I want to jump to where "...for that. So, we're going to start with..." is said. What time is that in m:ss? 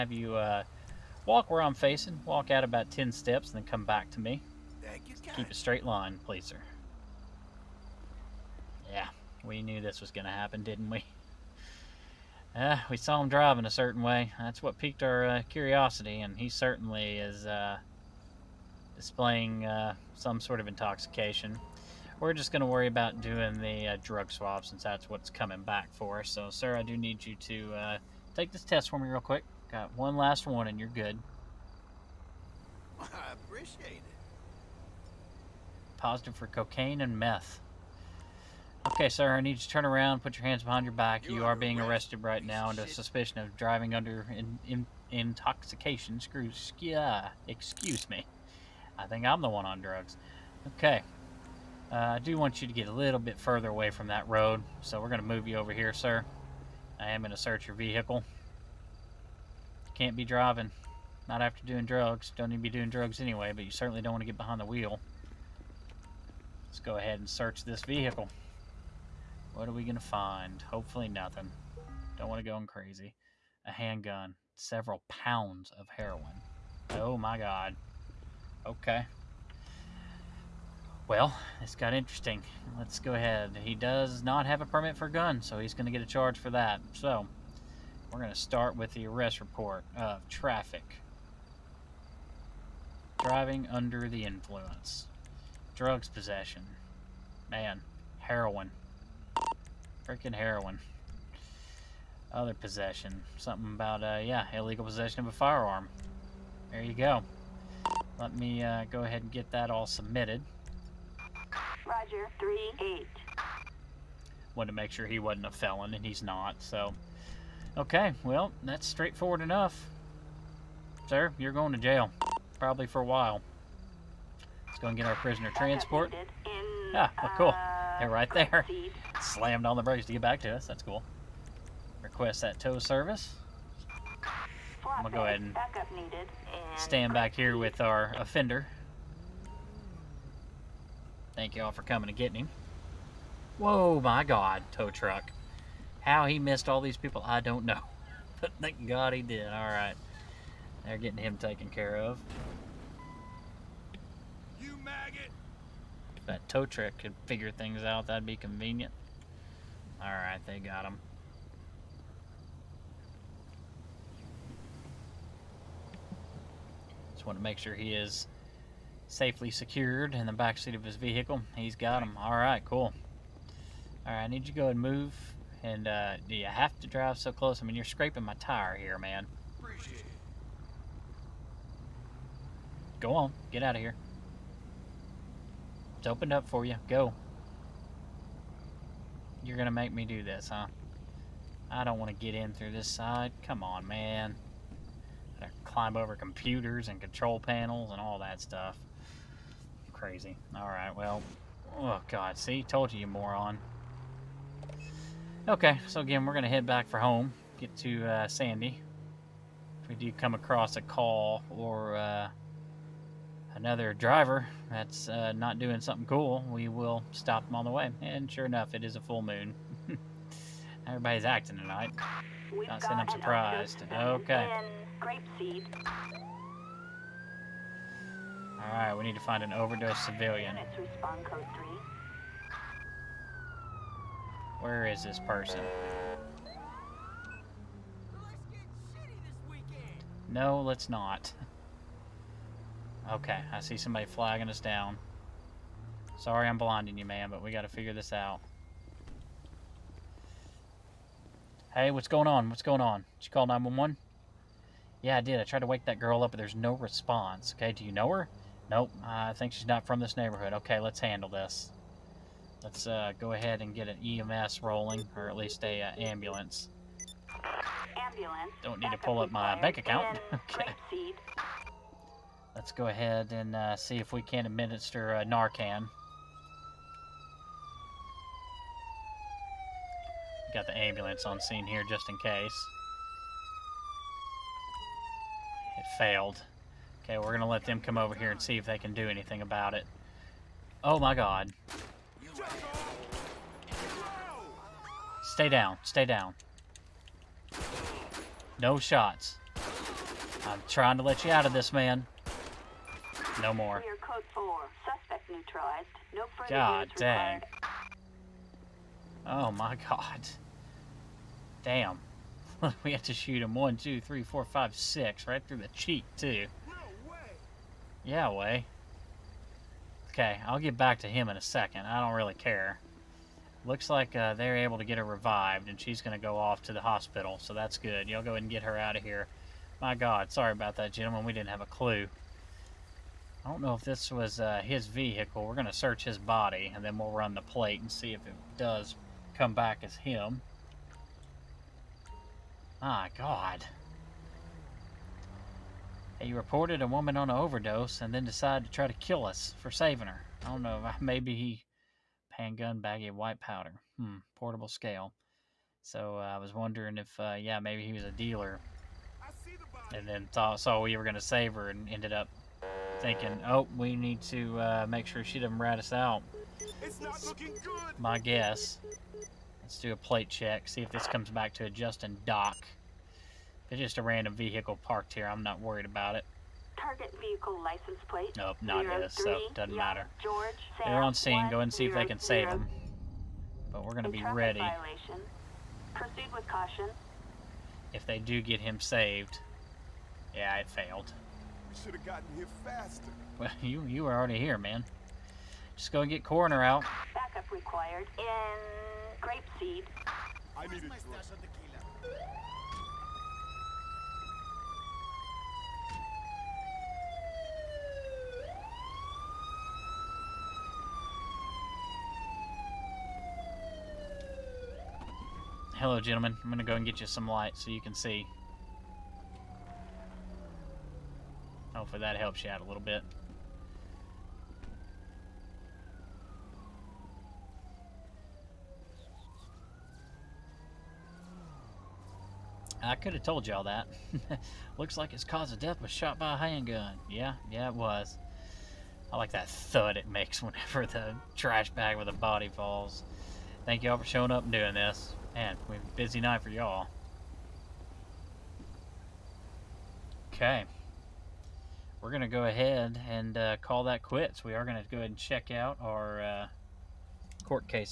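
1:26.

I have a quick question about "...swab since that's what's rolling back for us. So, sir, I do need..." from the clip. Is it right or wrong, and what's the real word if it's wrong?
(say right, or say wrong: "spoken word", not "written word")
wrong: "coming", not "rolling".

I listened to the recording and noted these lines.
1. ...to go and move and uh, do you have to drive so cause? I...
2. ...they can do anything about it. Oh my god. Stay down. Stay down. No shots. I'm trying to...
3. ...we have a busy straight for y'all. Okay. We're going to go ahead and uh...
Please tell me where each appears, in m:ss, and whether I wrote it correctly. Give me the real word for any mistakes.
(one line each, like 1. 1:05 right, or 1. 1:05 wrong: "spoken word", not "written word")
1. 2:54 wrong: "close", not "cause"
2. 4:48 right
3. 7:25 wrong: "night", not "straight".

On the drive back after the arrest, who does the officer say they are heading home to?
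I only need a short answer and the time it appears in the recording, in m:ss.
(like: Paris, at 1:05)
Sandy, at 3:28.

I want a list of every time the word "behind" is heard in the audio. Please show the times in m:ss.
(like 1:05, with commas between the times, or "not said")
0:40, 1:04.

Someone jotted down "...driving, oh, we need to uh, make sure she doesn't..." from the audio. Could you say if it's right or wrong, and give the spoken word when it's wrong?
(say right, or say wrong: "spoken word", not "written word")
wrong: "thinking", not "driving".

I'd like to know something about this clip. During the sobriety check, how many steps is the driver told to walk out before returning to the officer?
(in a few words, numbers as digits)
10.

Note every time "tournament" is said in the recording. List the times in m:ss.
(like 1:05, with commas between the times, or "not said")
not said.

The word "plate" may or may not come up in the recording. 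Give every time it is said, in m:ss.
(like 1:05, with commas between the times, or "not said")
5:37, 6:09, 6:18.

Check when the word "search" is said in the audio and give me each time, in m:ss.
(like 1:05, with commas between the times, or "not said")
0:57, 1:07, 5:35.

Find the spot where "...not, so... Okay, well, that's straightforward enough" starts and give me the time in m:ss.
1:56.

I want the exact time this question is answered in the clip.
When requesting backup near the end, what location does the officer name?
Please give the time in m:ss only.
6:39.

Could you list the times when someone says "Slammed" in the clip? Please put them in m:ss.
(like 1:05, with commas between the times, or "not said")
2:09.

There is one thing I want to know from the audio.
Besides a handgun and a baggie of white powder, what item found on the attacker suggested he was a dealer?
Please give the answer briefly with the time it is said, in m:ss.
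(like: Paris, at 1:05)
Portable scale, at 5:54.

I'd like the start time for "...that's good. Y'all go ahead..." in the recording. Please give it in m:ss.
5:27.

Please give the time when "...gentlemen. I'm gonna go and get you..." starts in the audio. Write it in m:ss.
6:56.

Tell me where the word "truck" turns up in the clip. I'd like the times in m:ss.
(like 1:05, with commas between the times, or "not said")
2:24, 2:36.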